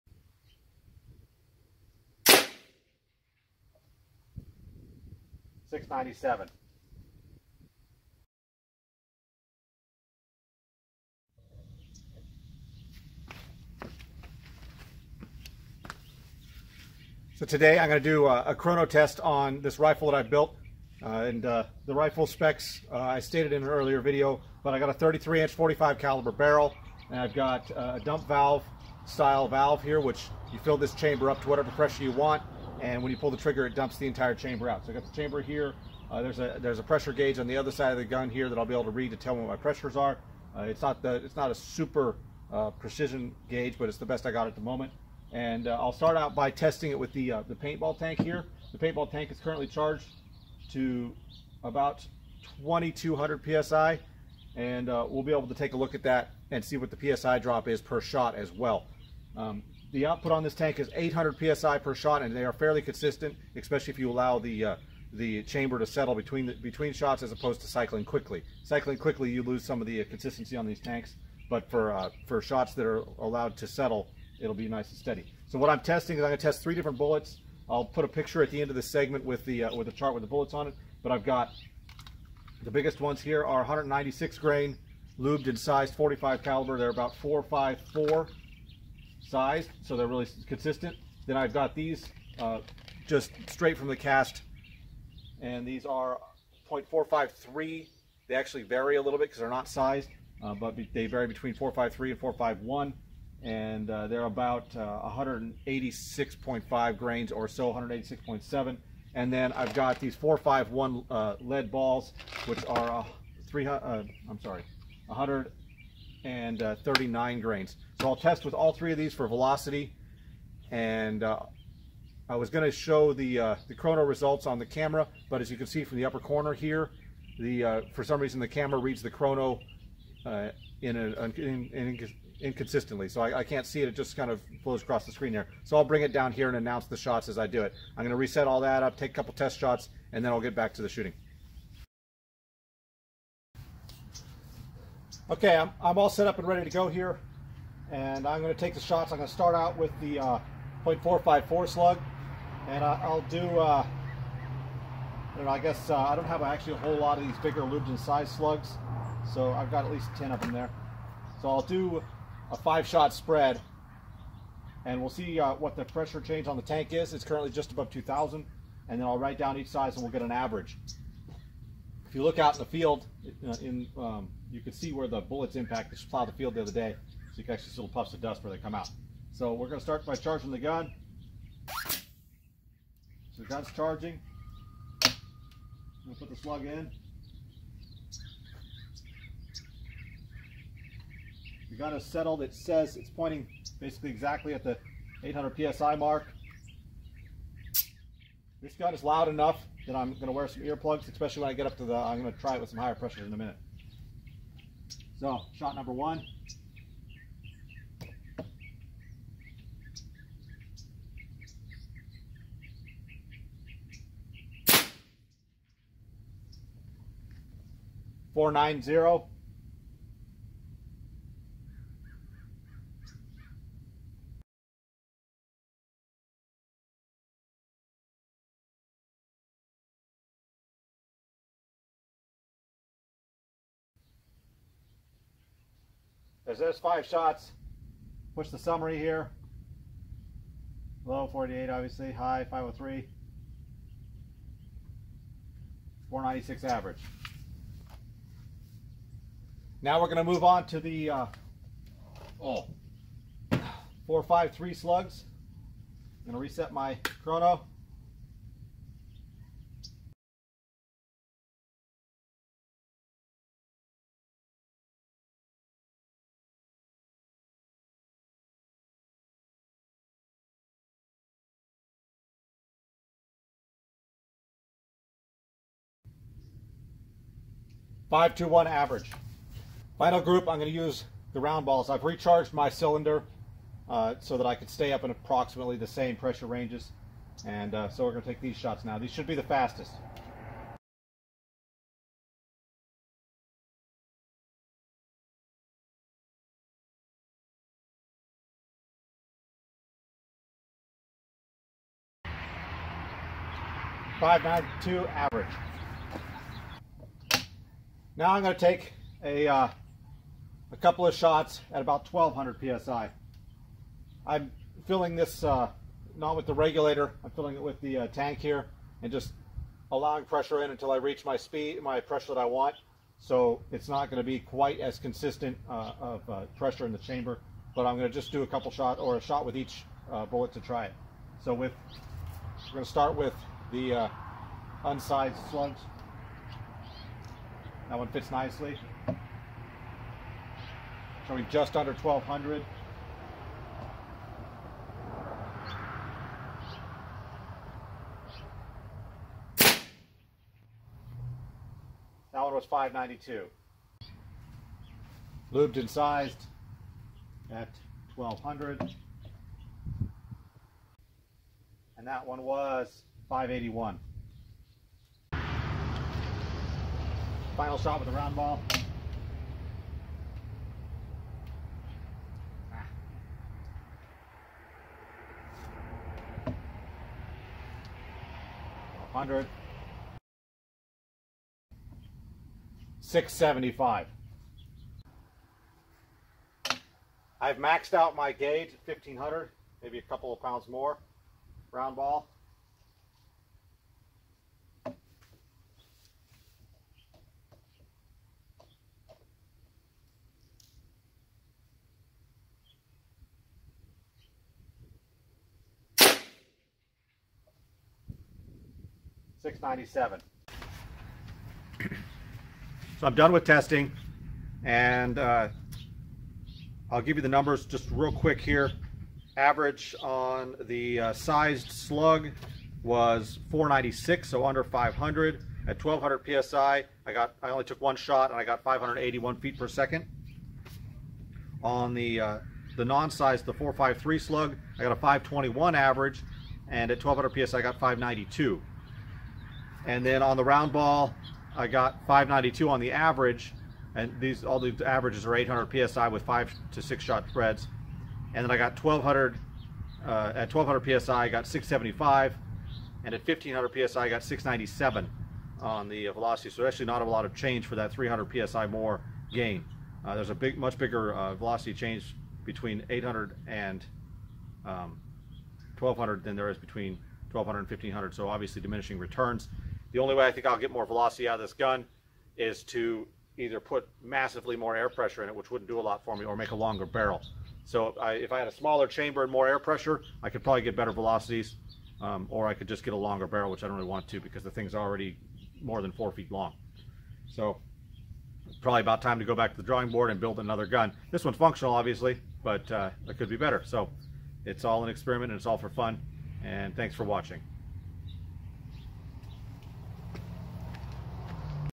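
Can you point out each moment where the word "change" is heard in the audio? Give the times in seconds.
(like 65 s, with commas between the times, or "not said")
166 s, 457 s, 461 s.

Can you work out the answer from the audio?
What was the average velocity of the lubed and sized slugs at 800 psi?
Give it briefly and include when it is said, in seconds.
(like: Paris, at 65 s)
496, at 246 s.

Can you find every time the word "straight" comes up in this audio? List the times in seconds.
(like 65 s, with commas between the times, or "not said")
93 s.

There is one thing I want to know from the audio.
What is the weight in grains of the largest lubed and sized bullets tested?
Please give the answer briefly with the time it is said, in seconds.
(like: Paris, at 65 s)
196 grain, at 83 s.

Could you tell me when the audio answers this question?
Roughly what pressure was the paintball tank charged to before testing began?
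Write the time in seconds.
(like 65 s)
52 s.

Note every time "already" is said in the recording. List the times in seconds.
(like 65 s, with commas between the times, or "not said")
484 s.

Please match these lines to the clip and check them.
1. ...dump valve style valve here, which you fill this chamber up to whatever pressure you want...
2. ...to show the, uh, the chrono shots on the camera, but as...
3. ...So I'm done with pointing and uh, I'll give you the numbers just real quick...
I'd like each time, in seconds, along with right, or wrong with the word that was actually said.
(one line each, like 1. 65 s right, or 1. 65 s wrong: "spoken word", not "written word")
1. 28 s right
2. 122 s wrong: "results", not "shots"
3. 412 s wrong: "testing", not "pointing".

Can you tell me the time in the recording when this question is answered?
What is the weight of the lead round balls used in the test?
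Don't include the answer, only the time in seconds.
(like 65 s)
115 s.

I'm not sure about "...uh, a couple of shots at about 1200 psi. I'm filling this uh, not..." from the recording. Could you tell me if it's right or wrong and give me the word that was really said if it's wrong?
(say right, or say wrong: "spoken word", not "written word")
right.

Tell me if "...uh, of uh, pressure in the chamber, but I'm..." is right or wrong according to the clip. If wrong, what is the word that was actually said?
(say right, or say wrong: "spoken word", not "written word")
right.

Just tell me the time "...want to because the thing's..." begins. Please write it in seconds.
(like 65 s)
483 s.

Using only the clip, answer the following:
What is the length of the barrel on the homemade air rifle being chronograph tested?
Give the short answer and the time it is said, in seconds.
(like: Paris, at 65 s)
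33 inch, at 24 s.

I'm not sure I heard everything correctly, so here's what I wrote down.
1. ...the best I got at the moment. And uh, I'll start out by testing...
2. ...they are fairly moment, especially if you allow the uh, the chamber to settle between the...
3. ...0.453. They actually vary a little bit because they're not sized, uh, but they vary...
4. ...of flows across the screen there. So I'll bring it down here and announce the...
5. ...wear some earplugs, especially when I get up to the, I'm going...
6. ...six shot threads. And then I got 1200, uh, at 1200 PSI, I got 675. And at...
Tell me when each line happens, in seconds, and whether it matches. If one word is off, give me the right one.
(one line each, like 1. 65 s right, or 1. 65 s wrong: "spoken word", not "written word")
1. 43 s right
2. 62 s wrong: "consistent", not "moment"
3. 96 s right
4. 134 s right
5. 200 s right
6. 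446 s right.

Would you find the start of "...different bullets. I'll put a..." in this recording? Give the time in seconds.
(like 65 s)
76 s.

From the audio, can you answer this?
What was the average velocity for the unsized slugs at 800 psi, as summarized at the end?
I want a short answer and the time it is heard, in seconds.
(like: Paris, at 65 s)
521, at 434 s.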